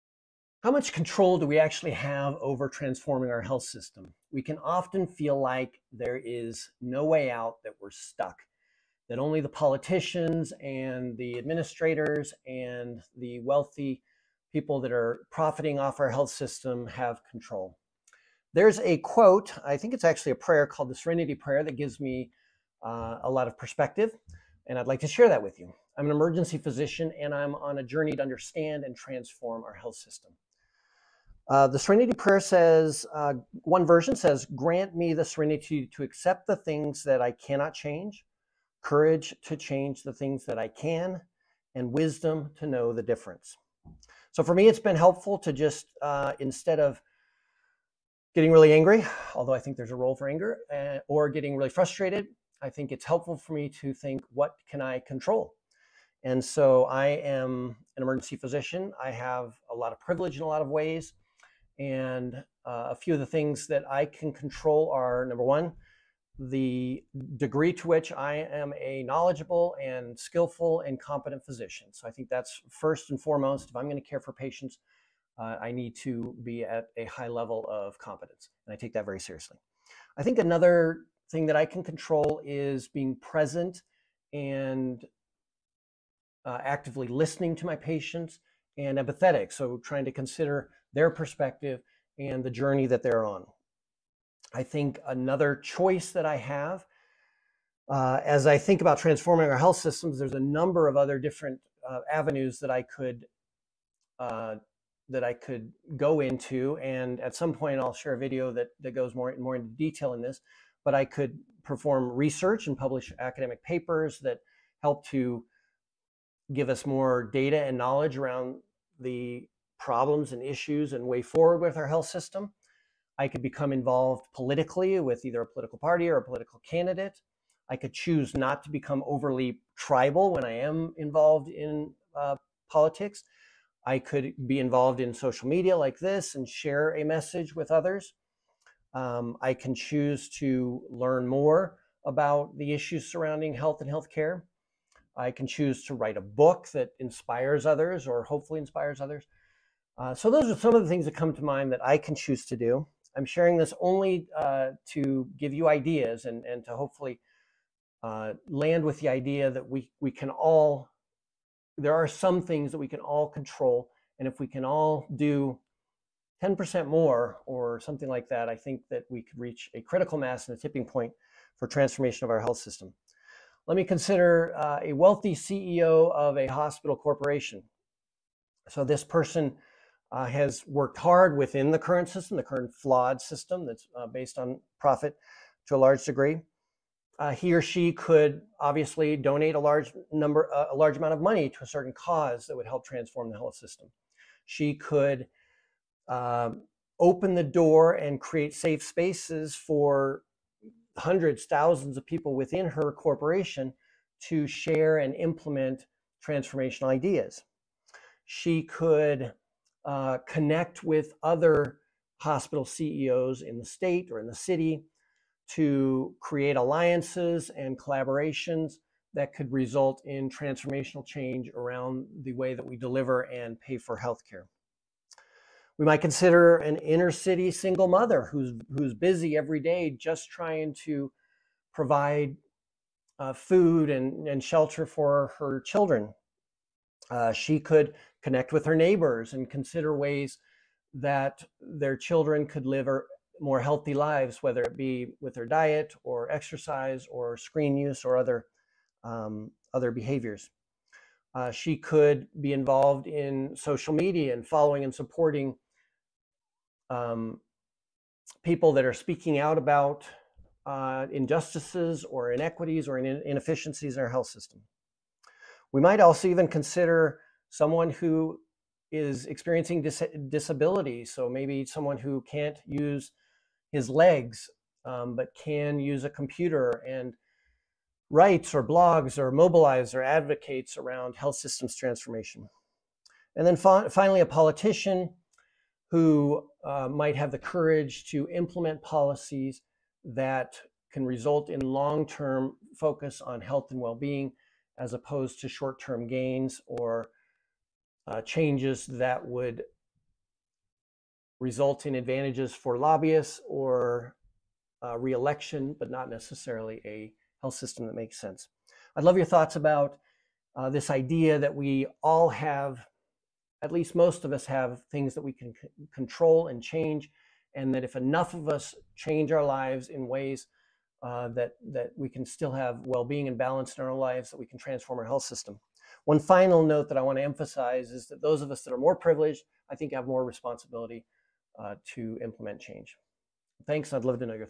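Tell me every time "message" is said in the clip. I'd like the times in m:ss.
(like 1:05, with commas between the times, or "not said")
2:17.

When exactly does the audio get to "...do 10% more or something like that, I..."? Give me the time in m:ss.
2:45.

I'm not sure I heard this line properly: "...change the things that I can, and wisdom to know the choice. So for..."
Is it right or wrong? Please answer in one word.
wrong.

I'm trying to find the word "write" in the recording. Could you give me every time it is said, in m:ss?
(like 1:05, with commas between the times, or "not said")
2:25, 4:38.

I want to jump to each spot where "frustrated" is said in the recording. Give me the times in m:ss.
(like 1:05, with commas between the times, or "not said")
0:51.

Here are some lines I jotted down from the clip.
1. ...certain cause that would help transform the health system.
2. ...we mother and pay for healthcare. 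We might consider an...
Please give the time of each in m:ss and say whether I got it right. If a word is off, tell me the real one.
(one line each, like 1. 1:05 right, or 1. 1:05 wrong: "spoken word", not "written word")
1. 3:11 right
2. 3:42 wrong: "deliver", not "mother".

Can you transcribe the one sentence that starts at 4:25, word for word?
We might also even consider someone who is experiencing dis disability.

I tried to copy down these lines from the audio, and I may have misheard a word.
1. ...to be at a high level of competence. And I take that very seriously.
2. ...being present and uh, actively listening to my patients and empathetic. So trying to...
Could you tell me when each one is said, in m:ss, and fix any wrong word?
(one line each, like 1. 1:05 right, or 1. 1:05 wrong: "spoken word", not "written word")
1. 1:15 right
2. 1:22 right.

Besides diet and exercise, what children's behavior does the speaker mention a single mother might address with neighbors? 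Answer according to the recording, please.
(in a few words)
Screen use.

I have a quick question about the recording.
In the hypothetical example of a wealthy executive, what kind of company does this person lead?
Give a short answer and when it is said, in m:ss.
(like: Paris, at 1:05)
Hospital corporation, at 2:56.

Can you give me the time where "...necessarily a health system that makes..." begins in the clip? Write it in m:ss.
5:06.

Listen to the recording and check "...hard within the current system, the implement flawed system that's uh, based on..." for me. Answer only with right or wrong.
wrong.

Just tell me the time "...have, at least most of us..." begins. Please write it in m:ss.
5:12.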